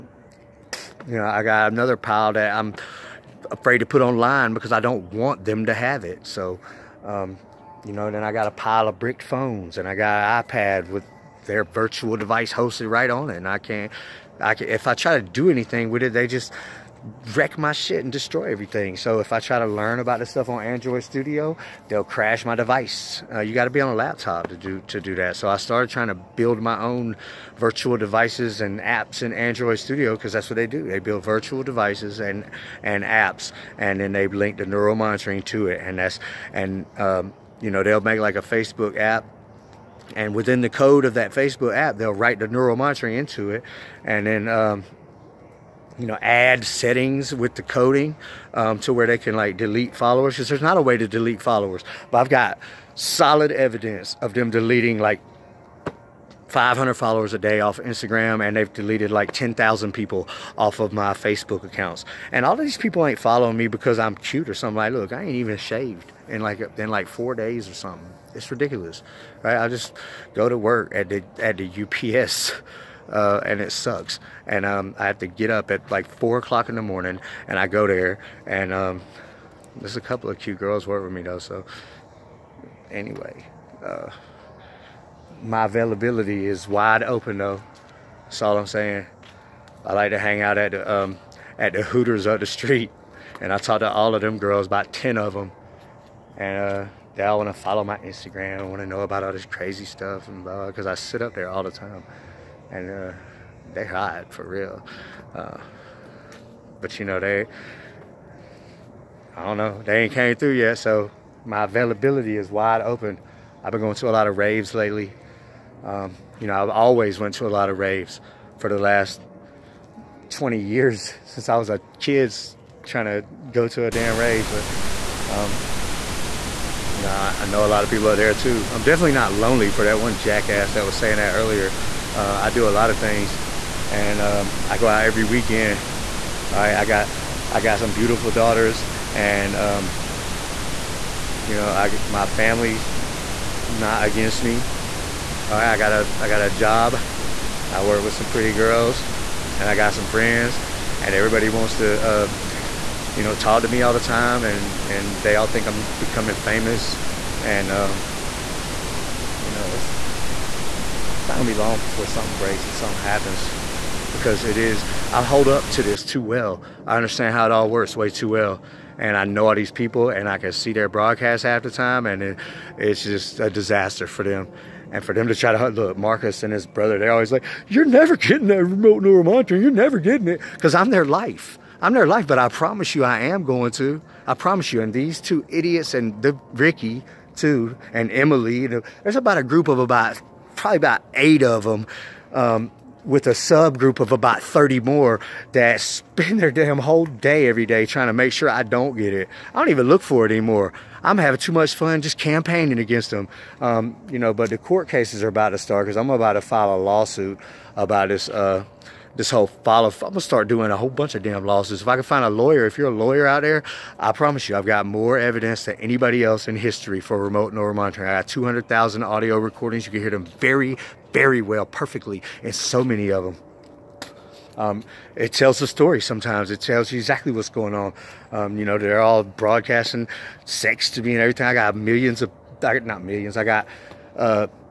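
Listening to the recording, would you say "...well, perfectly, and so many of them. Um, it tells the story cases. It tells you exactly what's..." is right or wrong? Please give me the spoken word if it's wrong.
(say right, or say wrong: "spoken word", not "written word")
wrong: "sometimes", not "cases".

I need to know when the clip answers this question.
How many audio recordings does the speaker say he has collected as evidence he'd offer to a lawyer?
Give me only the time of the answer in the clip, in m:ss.
3:38.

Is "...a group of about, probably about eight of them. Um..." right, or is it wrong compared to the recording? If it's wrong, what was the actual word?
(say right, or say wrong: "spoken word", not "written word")
right.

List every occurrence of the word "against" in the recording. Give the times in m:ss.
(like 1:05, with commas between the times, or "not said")
2:24, 3:22.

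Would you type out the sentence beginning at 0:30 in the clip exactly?
They build virtual devices and and apps, and then they link the neural monitoring to it.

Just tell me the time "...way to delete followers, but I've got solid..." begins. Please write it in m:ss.
0:50.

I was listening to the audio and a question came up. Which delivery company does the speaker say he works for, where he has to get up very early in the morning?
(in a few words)
UPS.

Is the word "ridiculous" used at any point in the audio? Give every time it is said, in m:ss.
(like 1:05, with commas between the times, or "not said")
1:08.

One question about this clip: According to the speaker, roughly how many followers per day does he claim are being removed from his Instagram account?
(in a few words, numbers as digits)
500.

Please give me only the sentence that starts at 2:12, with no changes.
Uh, I do a lot of things, and um, I go out every weekend.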